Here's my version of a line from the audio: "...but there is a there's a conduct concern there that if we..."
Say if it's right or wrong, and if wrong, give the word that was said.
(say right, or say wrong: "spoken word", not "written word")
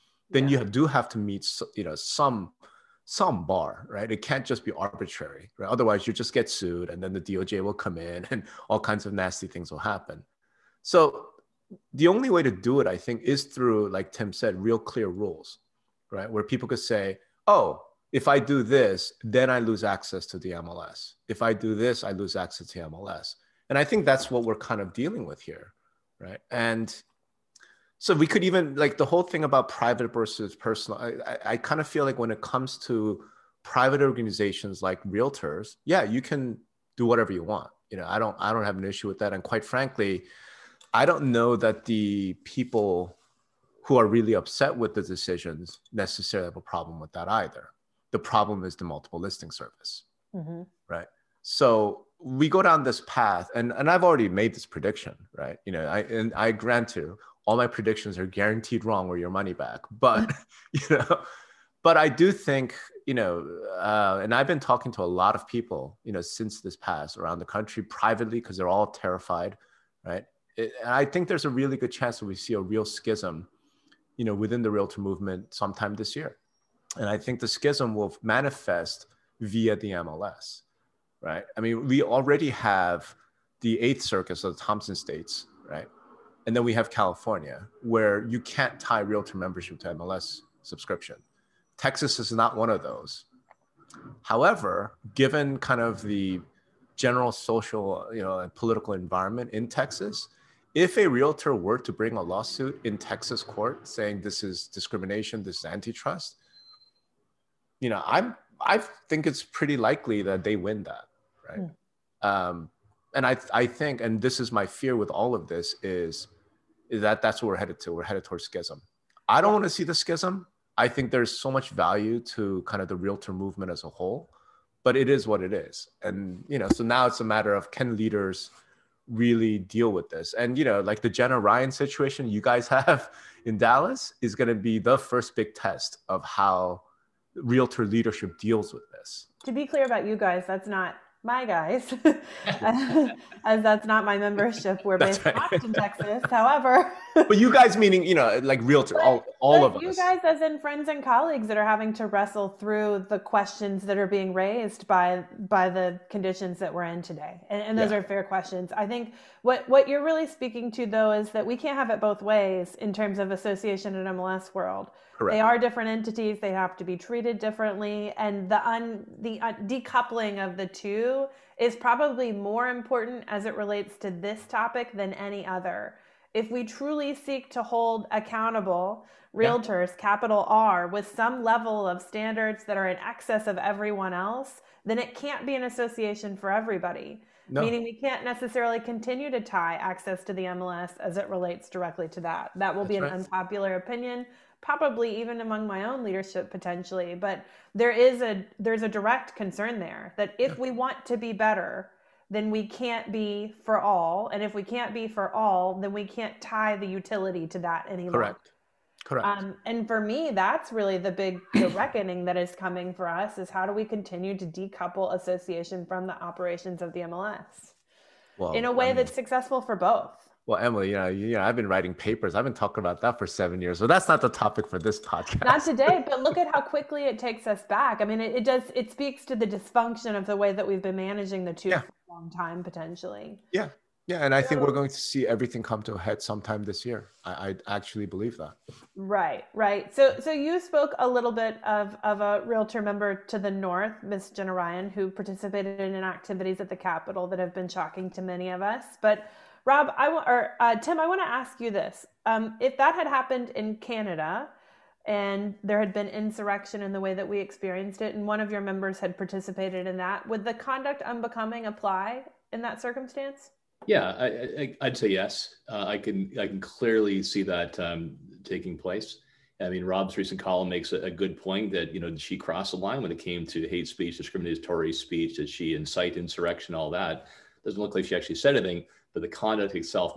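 wrong: "direct", not "conduct".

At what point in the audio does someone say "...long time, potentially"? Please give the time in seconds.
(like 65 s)
232 s.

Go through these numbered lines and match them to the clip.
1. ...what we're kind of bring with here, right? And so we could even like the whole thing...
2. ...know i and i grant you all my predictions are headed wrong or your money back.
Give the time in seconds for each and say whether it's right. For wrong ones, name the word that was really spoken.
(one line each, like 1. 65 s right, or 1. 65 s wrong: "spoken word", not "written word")
1. 24 s wrong: "dealing", not "bring"
2. 55 s wrong: "guaranteed", not "headed".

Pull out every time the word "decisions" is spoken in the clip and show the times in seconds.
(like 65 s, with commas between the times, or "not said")
45 s.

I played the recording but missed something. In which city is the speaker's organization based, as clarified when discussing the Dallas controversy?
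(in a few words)
Austin, Texas.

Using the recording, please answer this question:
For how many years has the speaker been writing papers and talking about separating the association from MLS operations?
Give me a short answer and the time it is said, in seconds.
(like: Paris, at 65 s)
7, at 223 s.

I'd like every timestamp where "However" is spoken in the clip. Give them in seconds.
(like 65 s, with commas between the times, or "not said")
94 s, 146 s.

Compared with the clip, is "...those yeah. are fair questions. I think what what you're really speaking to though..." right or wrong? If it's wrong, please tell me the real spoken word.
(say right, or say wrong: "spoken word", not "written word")
right.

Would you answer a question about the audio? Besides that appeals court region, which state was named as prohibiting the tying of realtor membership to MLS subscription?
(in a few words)
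California.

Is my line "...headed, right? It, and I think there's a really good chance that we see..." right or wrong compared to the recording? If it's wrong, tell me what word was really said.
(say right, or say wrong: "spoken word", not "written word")
wrong: "terrified", not "headed".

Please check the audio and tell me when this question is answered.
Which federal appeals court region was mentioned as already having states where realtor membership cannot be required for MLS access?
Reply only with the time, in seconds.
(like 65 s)
83 s.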